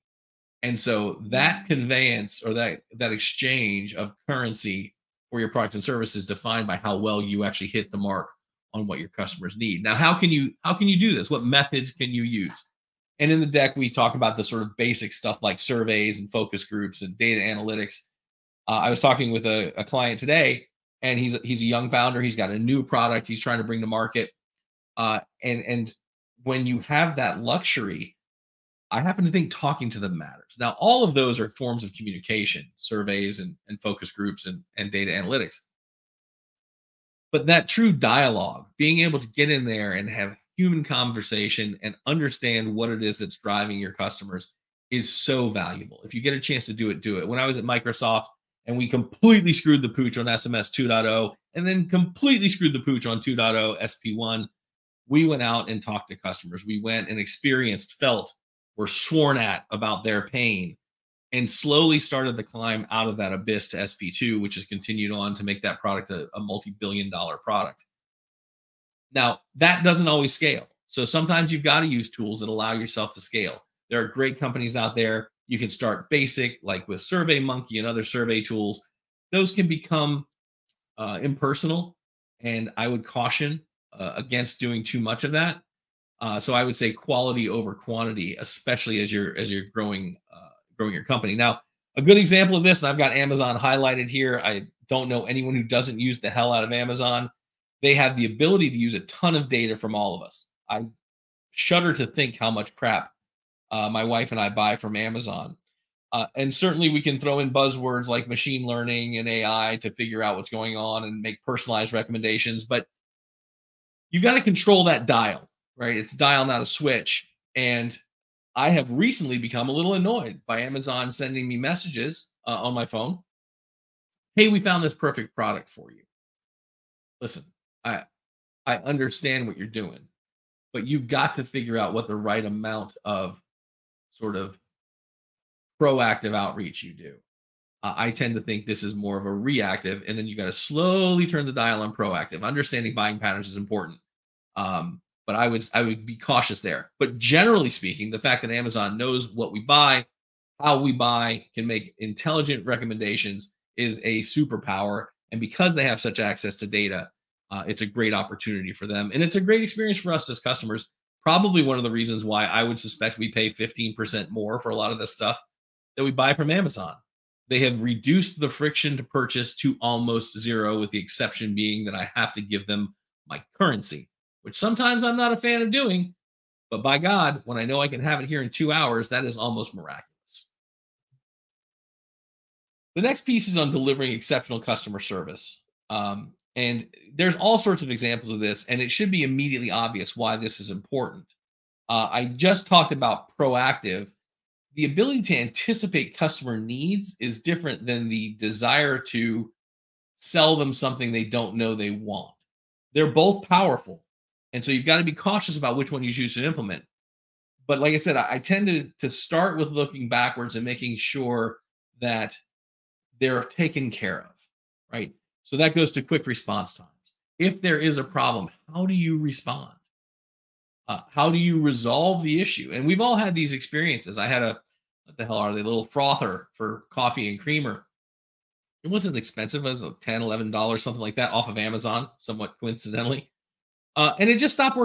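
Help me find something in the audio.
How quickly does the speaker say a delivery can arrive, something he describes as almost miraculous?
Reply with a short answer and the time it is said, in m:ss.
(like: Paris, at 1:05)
2 hours, at 2:58.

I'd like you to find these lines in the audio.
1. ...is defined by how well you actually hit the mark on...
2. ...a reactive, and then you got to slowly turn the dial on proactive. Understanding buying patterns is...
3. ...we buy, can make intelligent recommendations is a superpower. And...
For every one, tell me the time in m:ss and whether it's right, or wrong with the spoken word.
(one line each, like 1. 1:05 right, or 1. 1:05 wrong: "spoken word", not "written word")
1. 0:06 right
2. 2:19 right
3. 2:30 right.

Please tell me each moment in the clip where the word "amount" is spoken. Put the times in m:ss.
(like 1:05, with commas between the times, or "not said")
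2:12.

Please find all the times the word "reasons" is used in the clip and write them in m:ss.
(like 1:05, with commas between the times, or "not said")
2:41.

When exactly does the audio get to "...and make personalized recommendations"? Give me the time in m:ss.
1:51.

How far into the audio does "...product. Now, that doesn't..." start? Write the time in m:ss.
1:07.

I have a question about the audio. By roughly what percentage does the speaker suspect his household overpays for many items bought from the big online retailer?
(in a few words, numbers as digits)
15%.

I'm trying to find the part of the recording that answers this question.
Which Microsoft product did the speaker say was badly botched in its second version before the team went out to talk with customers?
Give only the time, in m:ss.
0:50.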